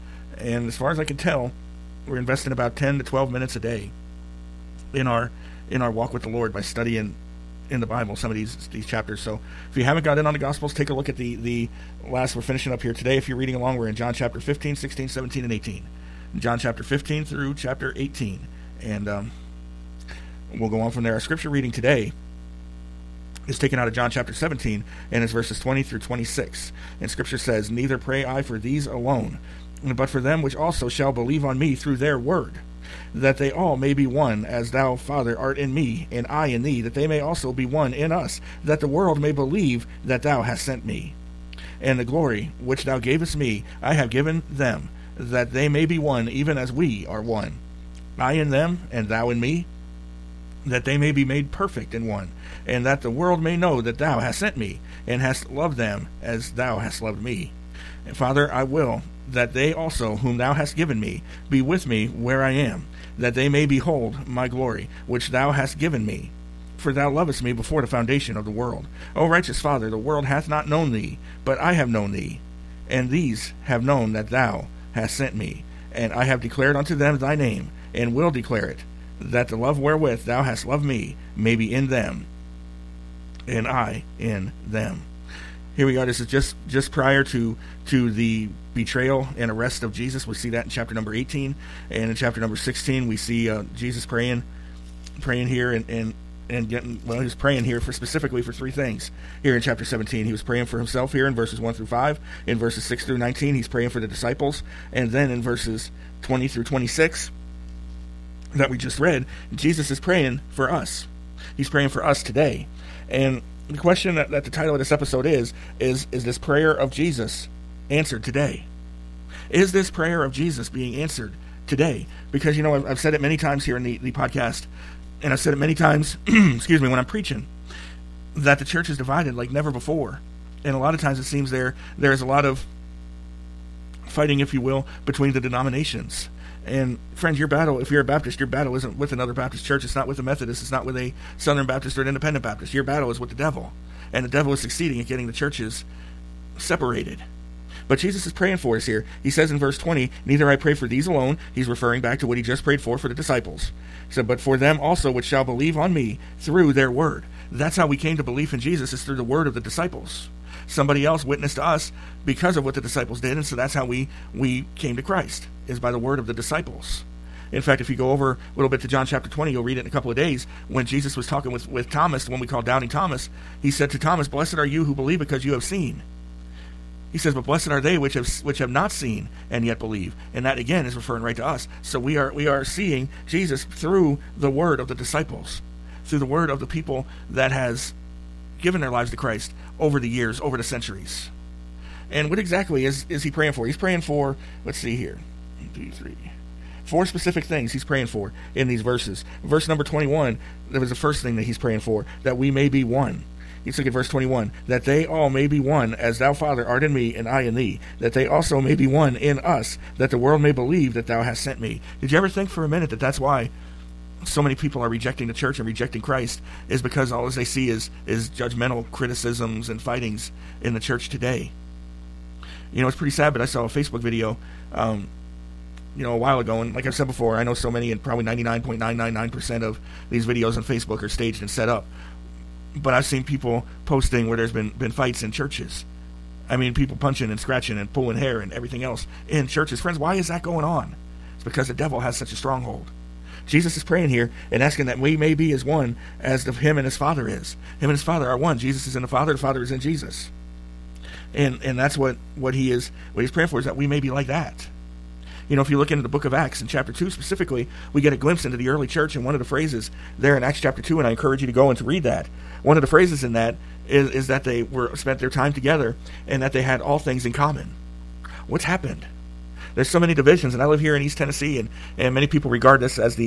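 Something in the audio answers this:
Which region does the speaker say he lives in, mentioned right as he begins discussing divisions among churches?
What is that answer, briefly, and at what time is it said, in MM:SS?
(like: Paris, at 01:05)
East Tennessee, at 04:31.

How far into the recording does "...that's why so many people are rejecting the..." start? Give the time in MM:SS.
03:33.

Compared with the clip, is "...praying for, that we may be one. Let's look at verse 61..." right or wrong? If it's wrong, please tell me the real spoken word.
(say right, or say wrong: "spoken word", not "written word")
wrong: "21", not "61".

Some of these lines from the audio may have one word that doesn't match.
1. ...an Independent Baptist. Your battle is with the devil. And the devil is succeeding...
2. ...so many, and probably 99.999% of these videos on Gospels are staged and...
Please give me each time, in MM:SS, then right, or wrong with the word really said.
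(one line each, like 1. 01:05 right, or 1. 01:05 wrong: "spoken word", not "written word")
1. 02:22 right
2. 03:47 wrong: "Facebook", not "Gospels".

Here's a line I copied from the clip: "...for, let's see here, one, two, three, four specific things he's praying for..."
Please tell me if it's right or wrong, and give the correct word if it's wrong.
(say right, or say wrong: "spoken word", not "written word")
right.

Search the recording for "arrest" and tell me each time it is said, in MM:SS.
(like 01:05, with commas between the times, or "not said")
01:29.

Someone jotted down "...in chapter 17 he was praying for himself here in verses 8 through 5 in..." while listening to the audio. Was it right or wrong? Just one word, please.
wrong.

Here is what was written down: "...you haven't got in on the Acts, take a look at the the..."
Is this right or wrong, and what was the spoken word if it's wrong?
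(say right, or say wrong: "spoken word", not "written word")
wrong: "Gospels", not "Acts".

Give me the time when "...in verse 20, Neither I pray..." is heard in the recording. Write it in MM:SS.
02:29.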